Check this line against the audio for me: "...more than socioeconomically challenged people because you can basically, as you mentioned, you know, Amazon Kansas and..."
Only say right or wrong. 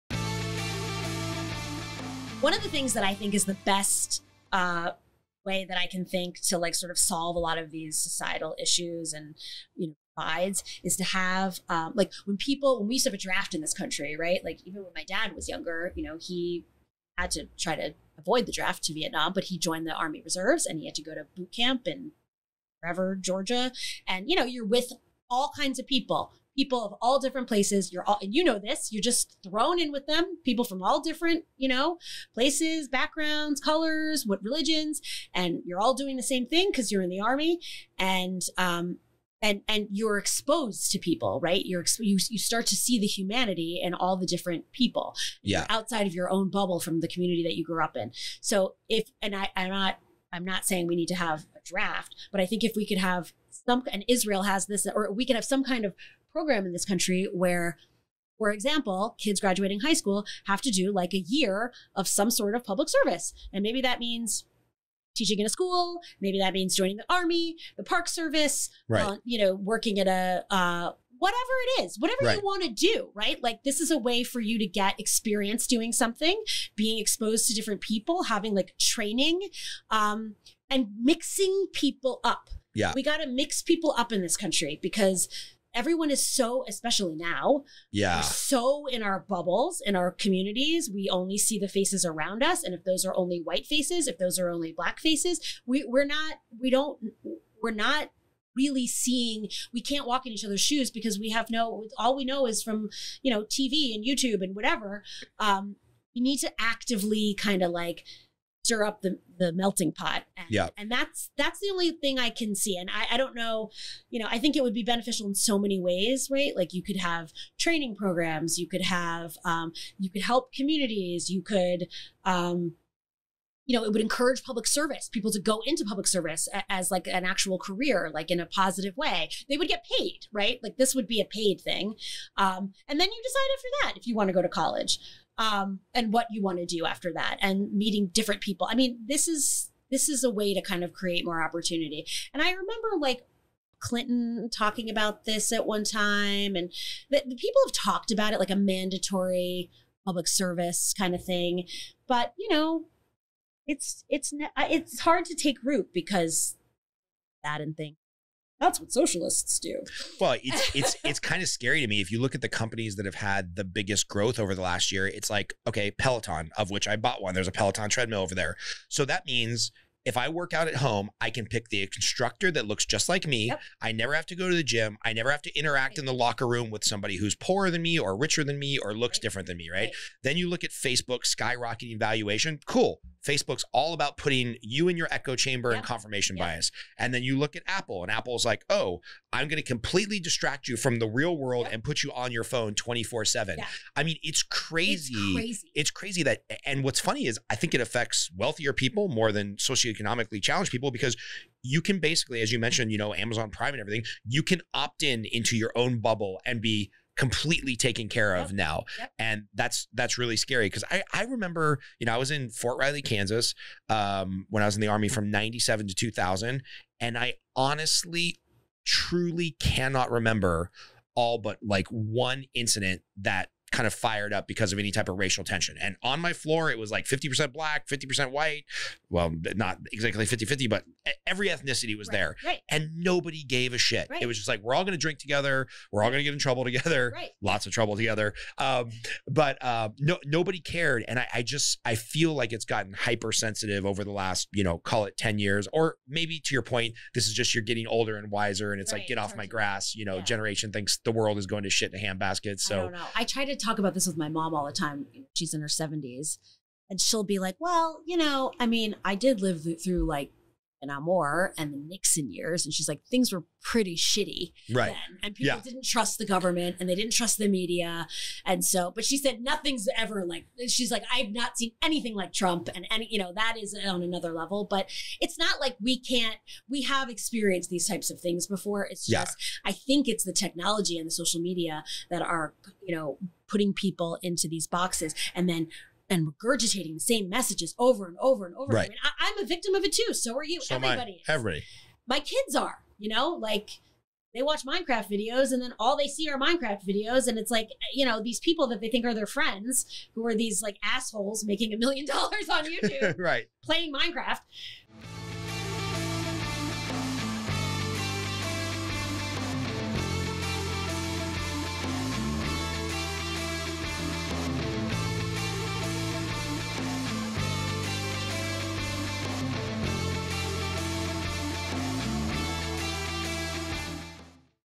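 wrong.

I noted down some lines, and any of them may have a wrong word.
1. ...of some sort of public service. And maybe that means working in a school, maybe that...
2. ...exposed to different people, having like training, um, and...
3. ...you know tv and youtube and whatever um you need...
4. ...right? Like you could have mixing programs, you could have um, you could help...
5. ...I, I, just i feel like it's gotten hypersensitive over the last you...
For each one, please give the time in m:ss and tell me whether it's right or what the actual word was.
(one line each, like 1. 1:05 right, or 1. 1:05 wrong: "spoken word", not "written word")
1. 1:01 wrong: "teaching", not "working"
2. 1:16 right
3. 1:43 right
4. 1:56 wrong: "training", not "mixing"
5. 4:01 right.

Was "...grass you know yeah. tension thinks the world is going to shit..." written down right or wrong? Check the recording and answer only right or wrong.
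wrong.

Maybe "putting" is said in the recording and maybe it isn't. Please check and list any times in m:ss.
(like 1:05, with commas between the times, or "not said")
3:04, 4:43.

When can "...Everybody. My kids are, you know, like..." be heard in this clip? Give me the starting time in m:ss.
4:51.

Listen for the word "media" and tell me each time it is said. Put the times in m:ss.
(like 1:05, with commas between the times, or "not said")
4:27, 4:41.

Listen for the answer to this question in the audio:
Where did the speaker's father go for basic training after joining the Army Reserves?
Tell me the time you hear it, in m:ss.
0:23.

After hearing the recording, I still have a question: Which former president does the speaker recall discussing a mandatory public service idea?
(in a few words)
Clinton.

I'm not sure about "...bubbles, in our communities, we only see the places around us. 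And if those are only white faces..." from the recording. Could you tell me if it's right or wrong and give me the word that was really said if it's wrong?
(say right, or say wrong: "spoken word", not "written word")
wrong: "faces", not "places".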